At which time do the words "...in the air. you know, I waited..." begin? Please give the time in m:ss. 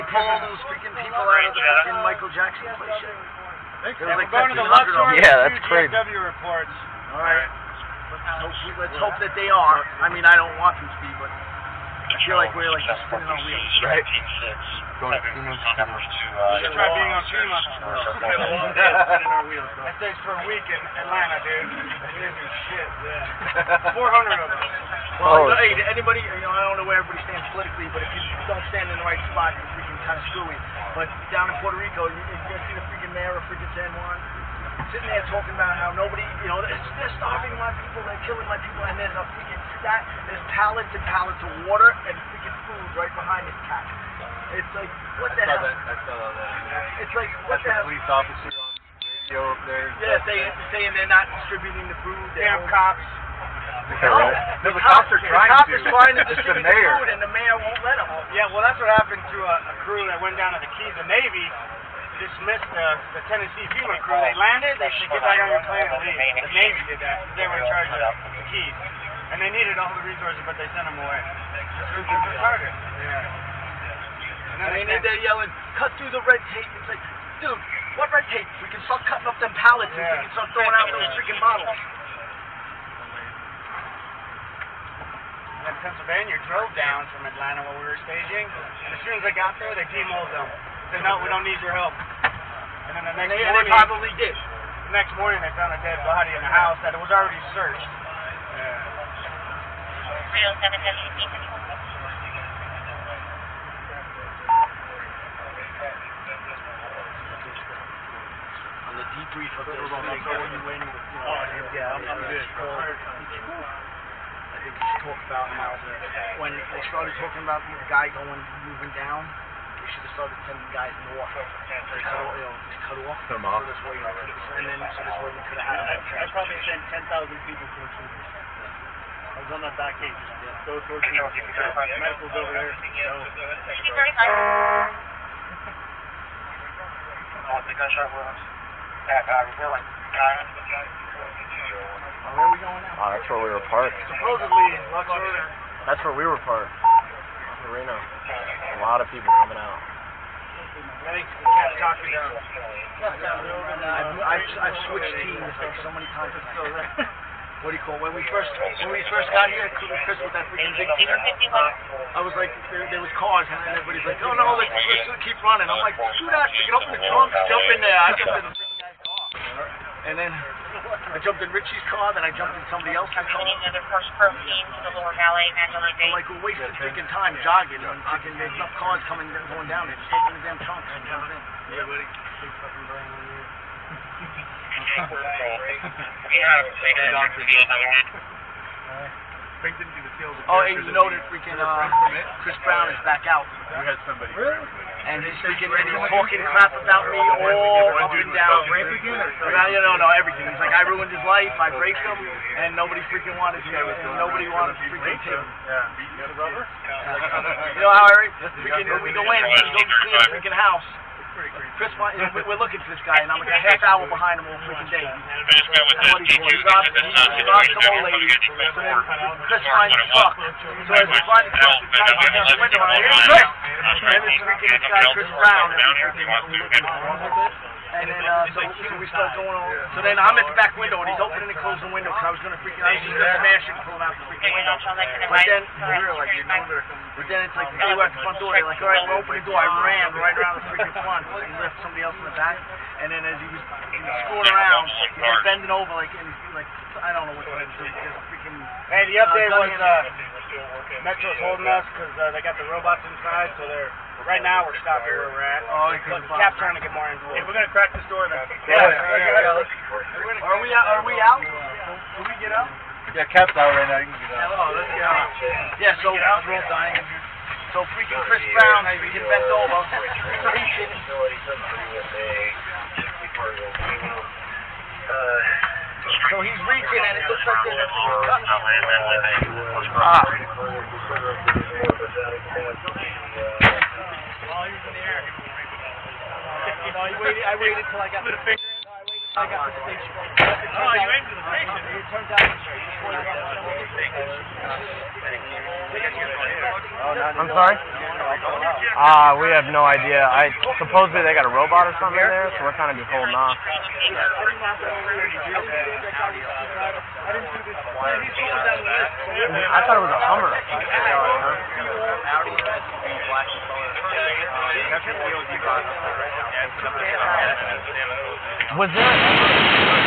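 4:44.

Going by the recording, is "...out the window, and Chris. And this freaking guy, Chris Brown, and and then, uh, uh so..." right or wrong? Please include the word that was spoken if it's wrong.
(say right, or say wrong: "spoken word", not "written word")
right.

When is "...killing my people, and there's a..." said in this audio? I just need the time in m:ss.
0:38.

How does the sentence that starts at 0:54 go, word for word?
no, the, the cops, cops are trying to.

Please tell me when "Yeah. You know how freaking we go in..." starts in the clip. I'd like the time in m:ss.
3:25.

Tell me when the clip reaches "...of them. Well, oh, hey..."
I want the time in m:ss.
0:23.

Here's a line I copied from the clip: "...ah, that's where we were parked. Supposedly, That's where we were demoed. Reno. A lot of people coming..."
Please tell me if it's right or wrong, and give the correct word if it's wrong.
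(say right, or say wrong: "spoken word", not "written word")
wrong: "parked", not "demoed".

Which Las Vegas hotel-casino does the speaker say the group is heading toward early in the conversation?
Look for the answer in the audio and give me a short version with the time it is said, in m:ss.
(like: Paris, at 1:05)
Luxor, at 0:04.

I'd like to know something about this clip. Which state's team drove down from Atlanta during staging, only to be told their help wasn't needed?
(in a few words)
Pennsylvania.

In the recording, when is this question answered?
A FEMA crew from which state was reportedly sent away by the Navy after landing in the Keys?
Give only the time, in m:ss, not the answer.
1:03.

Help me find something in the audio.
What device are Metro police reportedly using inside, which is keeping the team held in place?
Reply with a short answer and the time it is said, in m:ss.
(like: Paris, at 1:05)
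robots, at 4:12.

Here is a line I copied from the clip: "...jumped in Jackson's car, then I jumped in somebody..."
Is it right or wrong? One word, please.
wrong.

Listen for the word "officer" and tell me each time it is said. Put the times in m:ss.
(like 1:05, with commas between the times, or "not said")
0:48.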